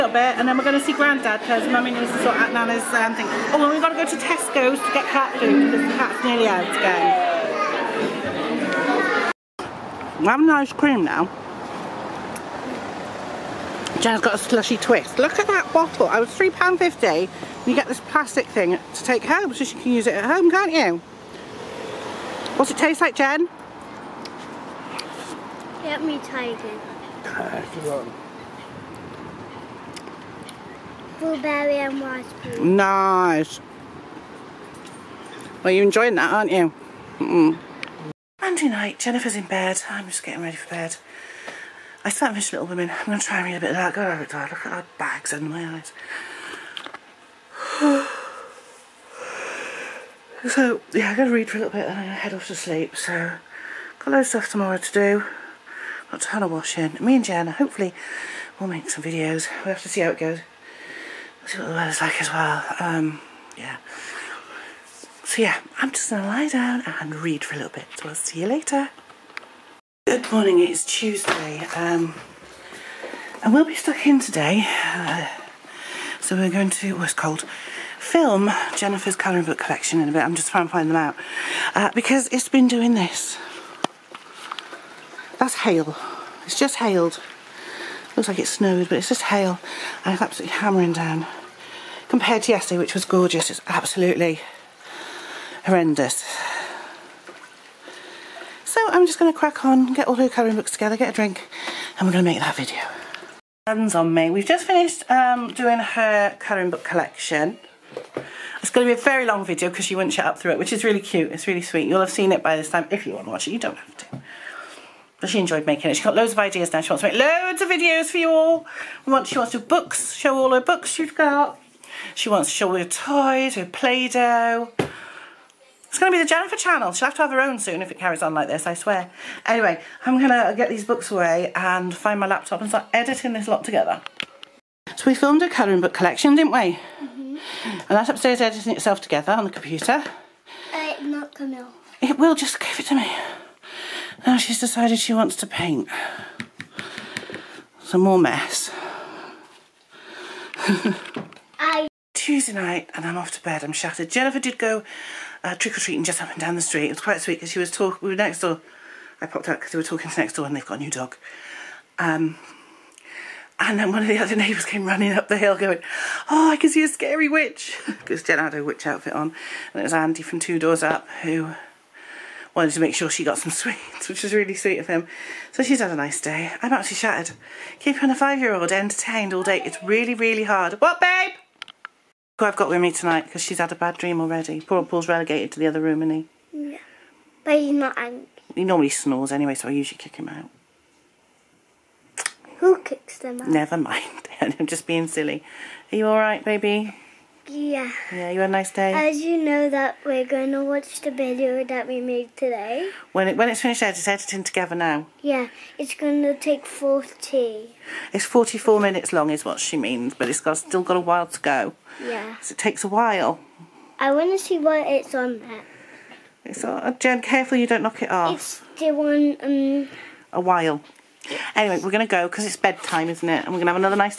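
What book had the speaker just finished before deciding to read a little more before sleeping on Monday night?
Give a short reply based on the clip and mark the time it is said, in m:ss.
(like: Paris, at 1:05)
Little Women, at 0:42.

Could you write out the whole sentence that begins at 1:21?
Uh, because it's been doing this that's hail.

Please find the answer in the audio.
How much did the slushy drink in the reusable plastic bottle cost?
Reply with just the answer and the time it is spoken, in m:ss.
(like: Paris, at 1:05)
£3.50, at 0:16.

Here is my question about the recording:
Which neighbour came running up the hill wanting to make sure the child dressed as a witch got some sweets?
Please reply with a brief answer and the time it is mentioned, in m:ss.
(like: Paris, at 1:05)
Andy, at 2:49.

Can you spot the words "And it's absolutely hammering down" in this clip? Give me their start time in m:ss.
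1:30.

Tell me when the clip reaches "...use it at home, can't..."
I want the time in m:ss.
0:19.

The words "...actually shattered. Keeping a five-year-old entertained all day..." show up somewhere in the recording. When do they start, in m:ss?
2:56.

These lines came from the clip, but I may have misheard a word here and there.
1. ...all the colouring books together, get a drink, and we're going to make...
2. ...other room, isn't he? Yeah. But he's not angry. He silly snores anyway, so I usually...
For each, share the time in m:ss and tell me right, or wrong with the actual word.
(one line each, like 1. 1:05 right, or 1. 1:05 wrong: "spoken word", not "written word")
1. 1:40 right
2. 3:05 wrong: "normally", not "silly".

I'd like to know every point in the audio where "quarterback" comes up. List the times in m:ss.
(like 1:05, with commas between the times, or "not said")
not said.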